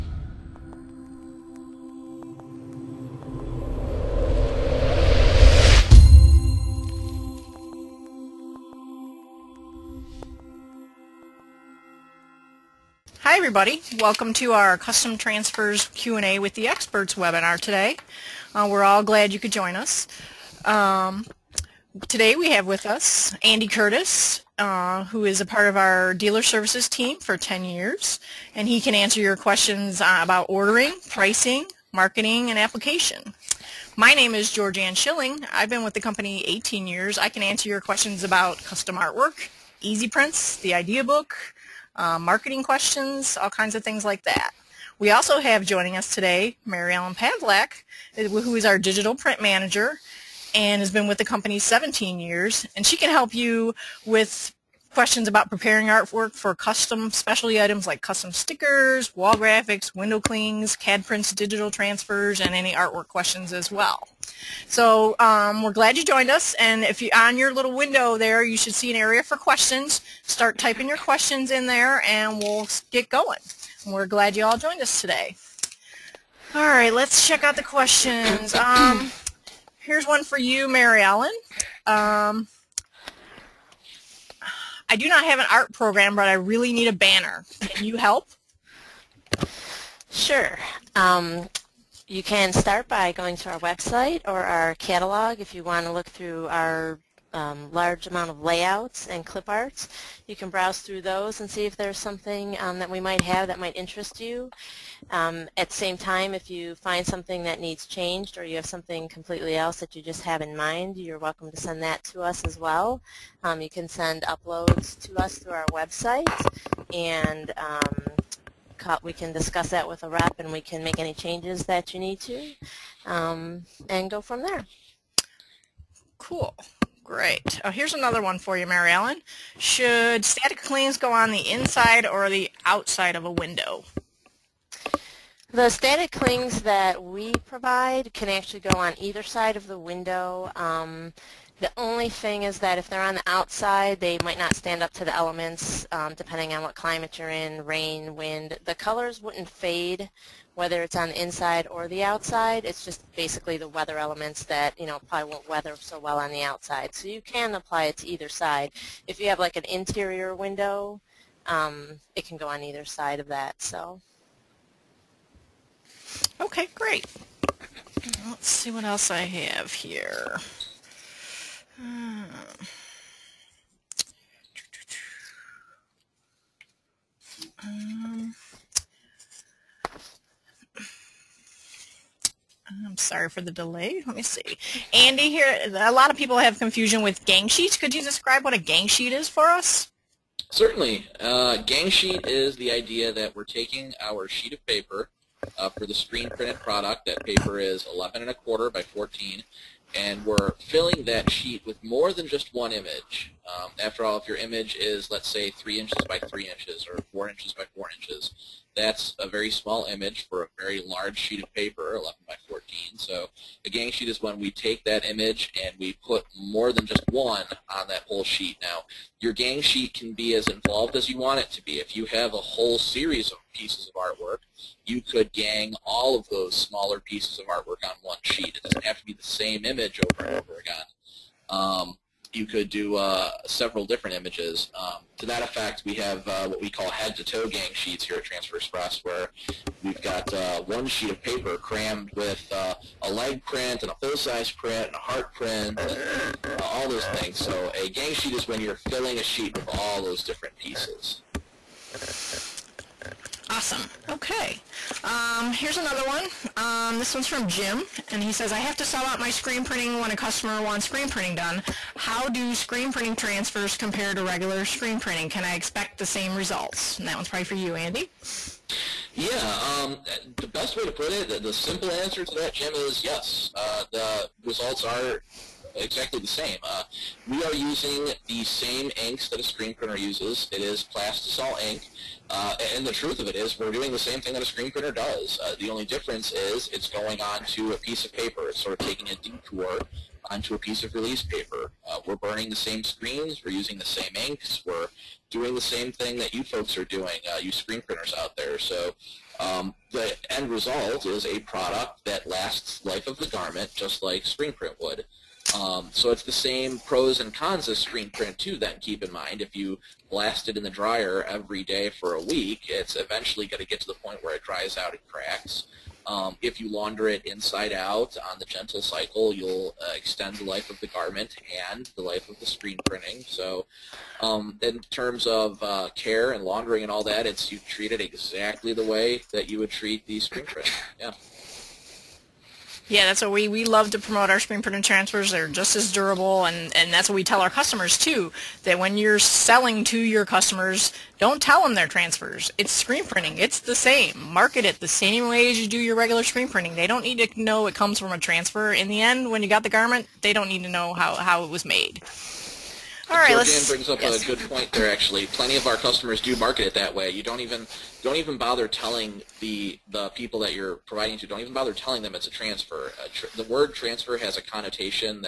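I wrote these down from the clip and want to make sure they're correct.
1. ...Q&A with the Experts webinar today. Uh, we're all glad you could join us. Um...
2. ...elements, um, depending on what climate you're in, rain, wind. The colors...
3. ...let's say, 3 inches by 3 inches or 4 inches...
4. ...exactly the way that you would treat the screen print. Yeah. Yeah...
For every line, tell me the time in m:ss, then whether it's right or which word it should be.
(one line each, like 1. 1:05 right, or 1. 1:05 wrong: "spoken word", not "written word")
1. 0:15 right
2. 2:25 right
3. 3:25 right
4. 5:27 right.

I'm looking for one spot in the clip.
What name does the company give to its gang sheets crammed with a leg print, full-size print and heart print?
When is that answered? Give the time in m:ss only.
3:56.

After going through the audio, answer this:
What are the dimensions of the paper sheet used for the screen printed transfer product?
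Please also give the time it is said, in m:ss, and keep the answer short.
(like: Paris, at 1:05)
11 1/4 by 14, at 3:17.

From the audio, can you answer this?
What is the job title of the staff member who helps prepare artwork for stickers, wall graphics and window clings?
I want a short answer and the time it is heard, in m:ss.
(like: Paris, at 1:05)
digital print manager, at 0:48.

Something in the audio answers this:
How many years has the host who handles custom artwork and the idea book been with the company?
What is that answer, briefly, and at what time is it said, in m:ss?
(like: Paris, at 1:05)
18, at 0:36.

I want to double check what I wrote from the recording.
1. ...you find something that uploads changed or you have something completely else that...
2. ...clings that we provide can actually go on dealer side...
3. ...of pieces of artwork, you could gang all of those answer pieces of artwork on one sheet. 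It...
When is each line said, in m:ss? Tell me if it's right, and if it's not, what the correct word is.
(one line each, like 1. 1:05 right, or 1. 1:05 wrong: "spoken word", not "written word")
1. 1:46 wrong: "needs", not "uploads"
2. 2:16 wrong: "either", not "dealer"
3. 3:43 wrong: "smaller", not "answer".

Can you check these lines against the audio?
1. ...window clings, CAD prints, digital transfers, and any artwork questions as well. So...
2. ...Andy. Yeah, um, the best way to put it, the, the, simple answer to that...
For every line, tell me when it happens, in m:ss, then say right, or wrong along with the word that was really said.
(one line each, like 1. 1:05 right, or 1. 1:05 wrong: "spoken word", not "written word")
1. 0:59 right
2. 4:27 right.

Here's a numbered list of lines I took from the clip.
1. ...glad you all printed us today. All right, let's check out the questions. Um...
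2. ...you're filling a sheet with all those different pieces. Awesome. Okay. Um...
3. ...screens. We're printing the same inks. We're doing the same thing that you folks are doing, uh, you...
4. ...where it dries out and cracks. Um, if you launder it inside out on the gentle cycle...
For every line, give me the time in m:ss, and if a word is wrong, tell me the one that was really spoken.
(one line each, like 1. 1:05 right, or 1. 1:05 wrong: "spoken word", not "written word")
1. 1:14 wrong: "joined", not "printed"
2. 4:08 right
3. 4:52 wrong: "using", not "printing"
4. 5:14 right.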